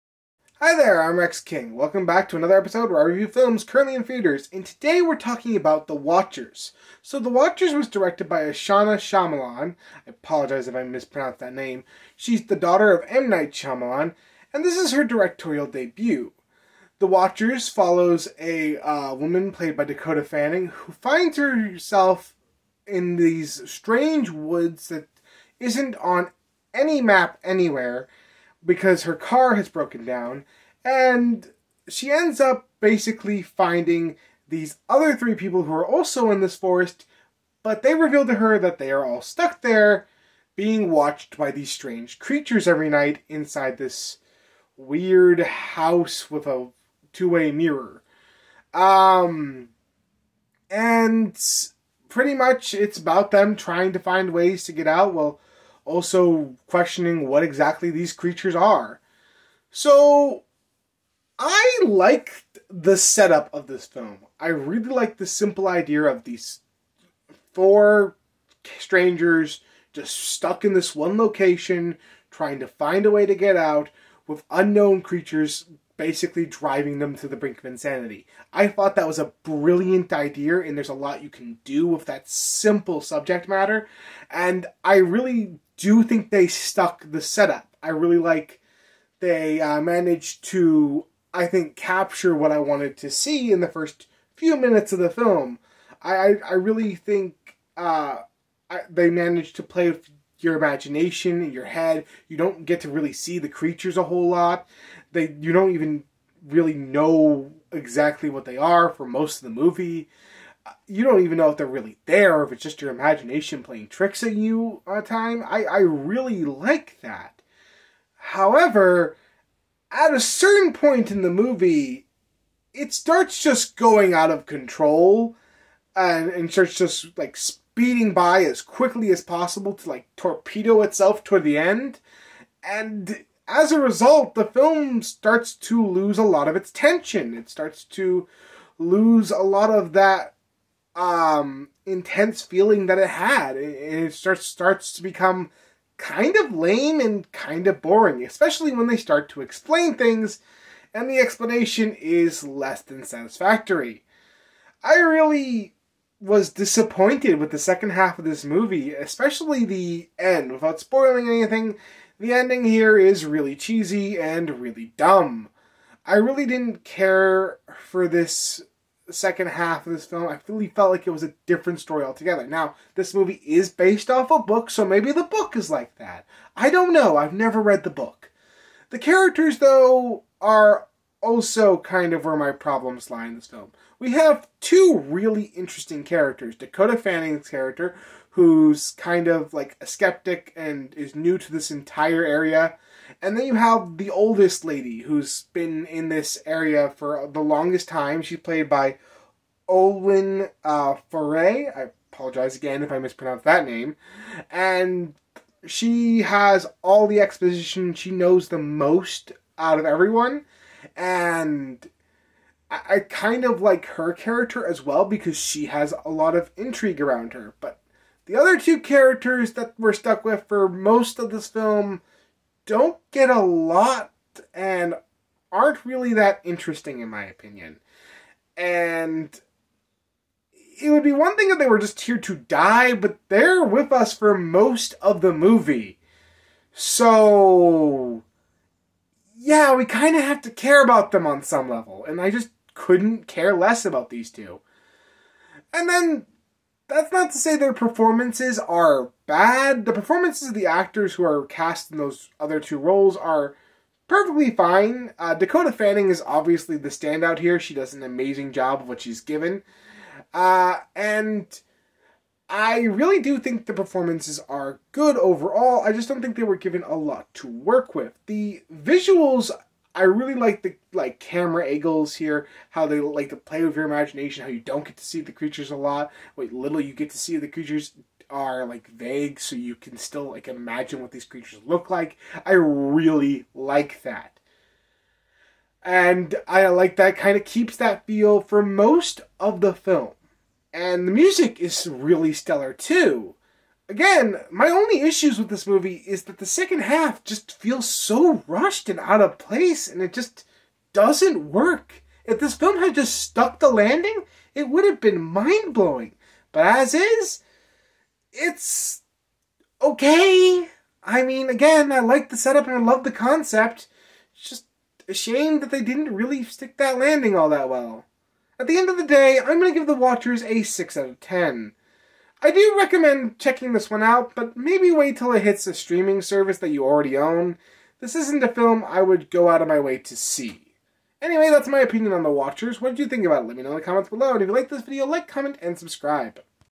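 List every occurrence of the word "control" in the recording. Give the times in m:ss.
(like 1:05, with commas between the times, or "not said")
2:04.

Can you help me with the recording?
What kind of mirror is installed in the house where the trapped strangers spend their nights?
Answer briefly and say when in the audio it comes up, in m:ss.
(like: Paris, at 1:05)
two-way mirror, at 0:47.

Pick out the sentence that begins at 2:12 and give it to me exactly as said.
And as a result, the film starts to lose a lot of its tension.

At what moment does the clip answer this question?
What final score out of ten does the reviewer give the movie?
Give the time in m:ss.
5:20.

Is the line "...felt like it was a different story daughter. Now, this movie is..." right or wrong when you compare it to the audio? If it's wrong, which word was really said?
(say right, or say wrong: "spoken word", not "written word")
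wrong: "altogether", not "daughter".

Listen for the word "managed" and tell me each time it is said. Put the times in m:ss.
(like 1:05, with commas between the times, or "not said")
1:29, 1:39.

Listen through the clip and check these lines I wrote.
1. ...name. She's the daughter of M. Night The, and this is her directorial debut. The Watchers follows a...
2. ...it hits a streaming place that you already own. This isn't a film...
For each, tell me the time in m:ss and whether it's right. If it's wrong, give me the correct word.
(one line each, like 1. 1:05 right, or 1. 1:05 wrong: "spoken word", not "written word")
1. 0:11 wrong: "Shyamalan", not "The"
2. 5:25 wrong: "service", not "place".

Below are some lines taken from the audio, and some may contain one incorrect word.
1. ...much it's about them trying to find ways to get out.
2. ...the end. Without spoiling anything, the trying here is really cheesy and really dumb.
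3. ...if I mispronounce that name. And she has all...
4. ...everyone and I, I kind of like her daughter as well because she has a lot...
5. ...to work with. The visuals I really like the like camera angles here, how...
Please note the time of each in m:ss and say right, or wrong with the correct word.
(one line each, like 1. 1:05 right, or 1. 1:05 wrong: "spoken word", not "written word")
1. 0:52 right
2. 2:39 wrong: "ending", not "trying"
3. 3:22 right
4. 3:29 wrong: "character", not "daughter"
5. 4:27 right.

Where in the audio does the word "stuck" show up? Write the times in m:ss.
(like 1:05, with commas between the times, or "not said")
0:39, 1:10, 1:26, 3:39, 5:03.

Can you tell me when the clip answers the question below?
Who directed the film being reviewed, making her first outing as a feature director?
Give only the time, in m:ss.
0:08.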